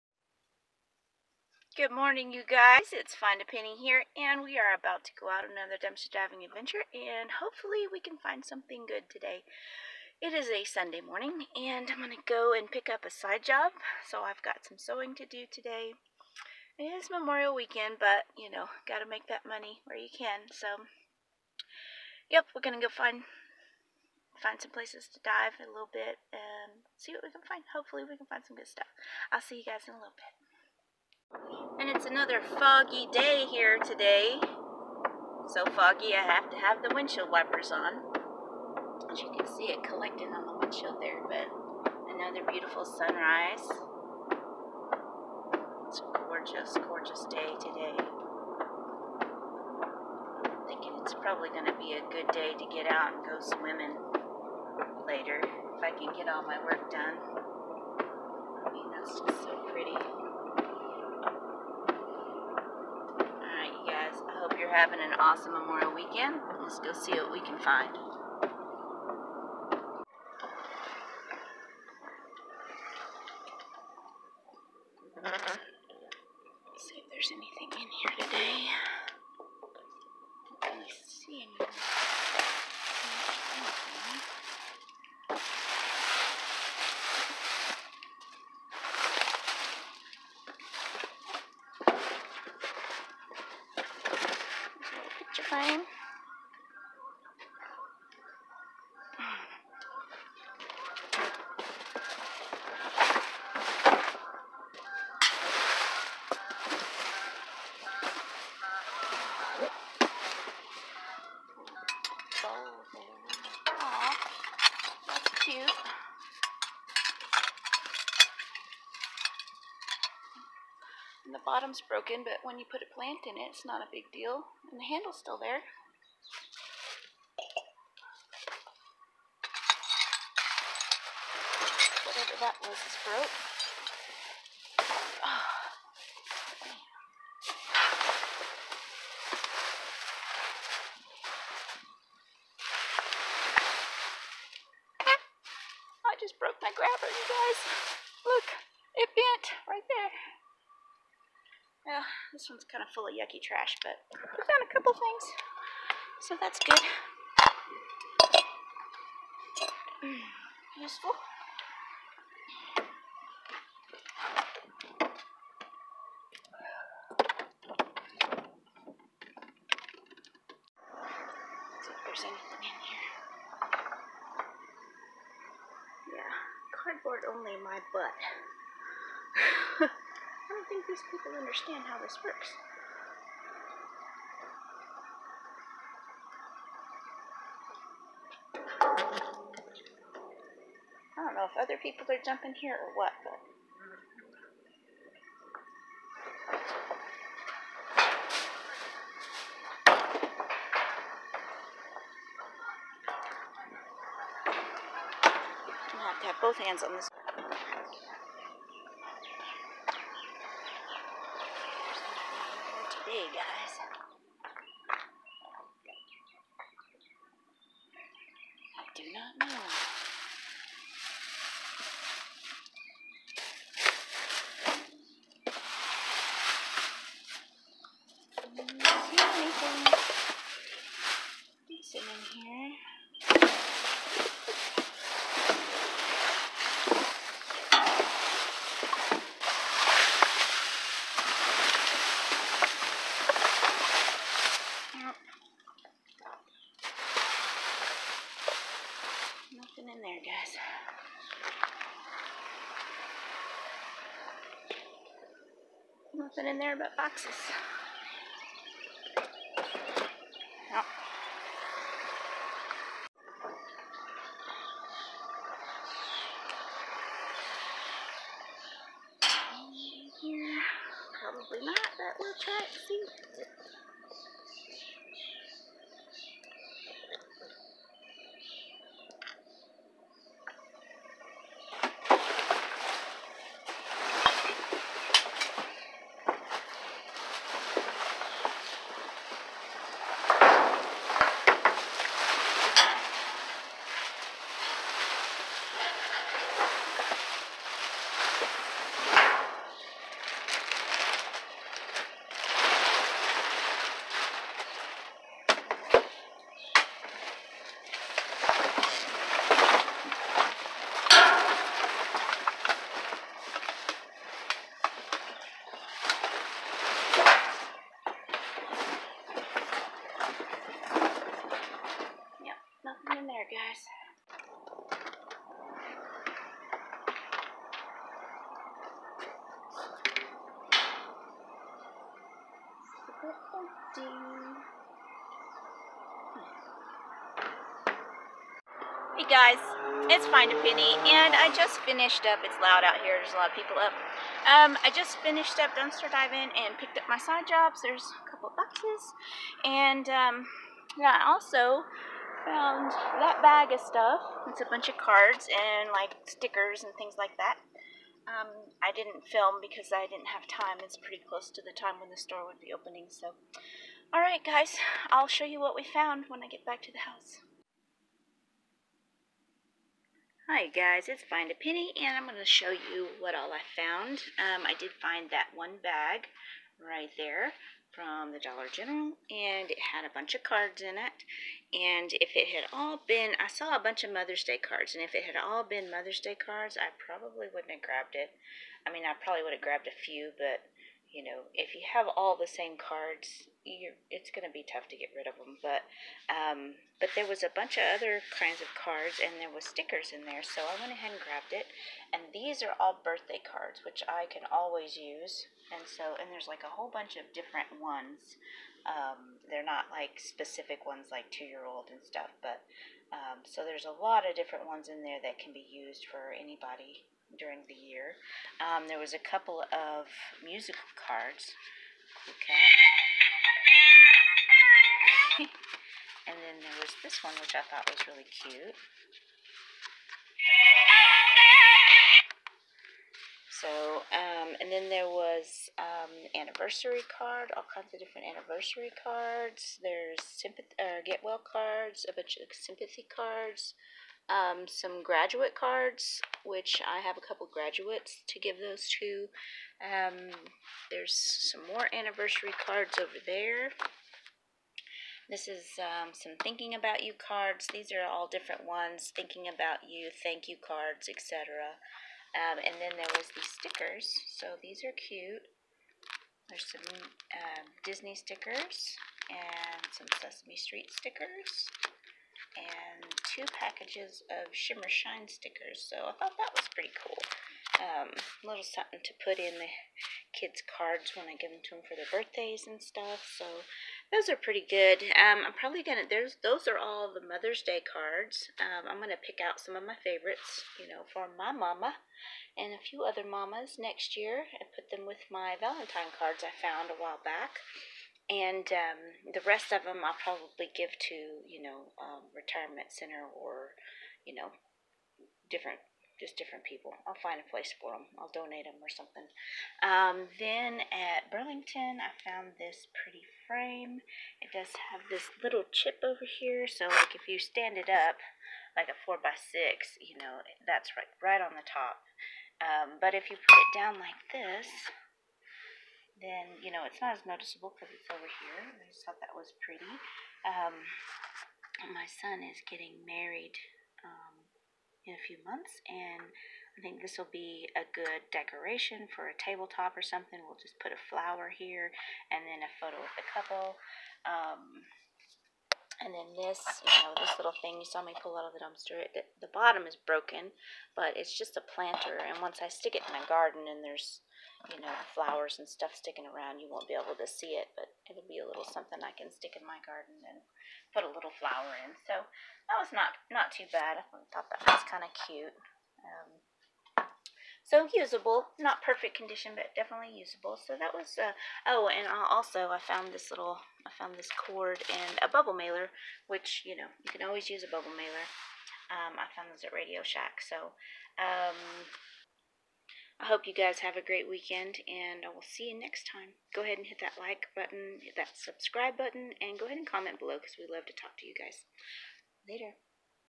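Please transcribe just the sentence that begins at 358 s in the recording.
Um, I didn't film because I didn't have time.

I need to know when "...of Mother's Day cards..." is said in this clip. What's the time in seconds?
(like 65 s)
384 s.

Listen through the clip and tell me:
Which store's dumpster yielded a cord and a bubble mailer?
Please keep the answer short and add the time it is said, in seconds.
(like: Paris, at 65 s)
Radio Shack, at 579 s.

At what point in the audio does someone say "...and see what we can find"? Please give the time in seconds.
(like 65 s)
26 s.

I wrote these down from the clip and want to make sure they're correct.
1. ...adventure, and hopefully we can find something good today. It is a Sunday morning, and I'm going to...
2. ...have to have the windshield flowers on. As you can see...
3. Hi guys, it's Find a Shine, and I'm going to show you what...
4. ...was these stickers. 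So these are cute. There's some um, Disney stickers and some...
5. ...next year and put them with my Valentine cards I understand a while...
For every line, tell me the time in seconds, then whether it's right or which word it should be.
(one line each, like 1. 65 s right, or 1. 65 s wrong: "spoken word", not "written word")
1. 6 s right
2. 36 s wrong: "wipers", not "flowers"
3. 370 s wrong: "Penny", not "Shine"
4. 463 s right
5. 493 s wrong: "found", not "understand".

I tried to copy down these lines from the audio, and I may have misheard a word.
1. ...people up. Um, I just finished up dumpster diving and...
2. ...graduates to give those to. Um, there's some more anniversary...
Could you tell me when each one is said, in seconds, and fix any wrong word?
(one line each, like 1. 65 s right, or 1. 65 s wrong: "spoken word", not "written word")
1. 343 s right
2. 447 s right.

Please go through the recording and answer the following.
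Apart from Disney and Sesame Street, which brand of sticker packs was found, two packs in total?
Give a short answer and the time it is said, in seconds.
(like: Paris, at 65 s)
Shimmer Shine, at 474 s.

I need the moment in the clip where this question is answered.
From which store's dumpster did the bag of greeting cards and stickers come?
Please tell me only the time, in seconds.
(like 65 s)
378 s.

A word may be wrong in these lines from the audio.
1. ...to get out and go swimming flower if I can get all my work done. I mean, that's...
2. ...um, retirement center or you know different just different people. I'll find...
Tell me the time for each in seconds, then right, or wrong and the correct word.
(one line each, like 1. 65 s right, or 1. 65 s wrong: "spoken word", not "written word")
1. 52 s wrong: "later", not "flower"
2. 501 s right.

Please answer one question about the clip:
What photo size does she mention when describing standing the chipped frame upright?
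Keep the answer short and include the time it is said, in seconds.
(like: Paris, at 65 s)
4 by 6, at 518 s.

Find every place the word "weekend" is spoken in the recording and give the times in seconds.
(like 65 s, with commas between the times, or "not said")
17 s, 65 s, 584 s.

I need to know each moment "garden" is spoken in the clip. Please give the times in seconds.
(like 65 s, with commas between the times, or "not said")
553 s, 559 s.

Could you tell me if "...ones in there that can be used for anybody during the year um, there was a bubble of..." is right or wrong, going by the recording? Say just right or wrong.
wrong.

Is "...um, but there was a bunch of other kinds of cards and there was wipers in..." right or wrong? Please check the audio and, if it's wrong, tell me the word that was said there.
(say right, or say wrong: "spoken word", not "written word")
wrong: "stickers", not "wipers".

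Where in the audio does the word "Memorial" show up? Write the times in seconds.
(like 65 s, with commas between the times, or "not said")
17 s, 65 s.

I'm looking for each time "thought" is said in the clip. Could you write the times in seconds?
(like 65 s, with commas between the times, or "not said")
427 s, 476 s, 529 s, 564 s.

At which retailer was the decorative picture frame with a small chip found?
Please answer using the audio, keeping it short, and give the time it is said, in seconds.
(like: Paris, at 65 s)
Burlington, at 511 s.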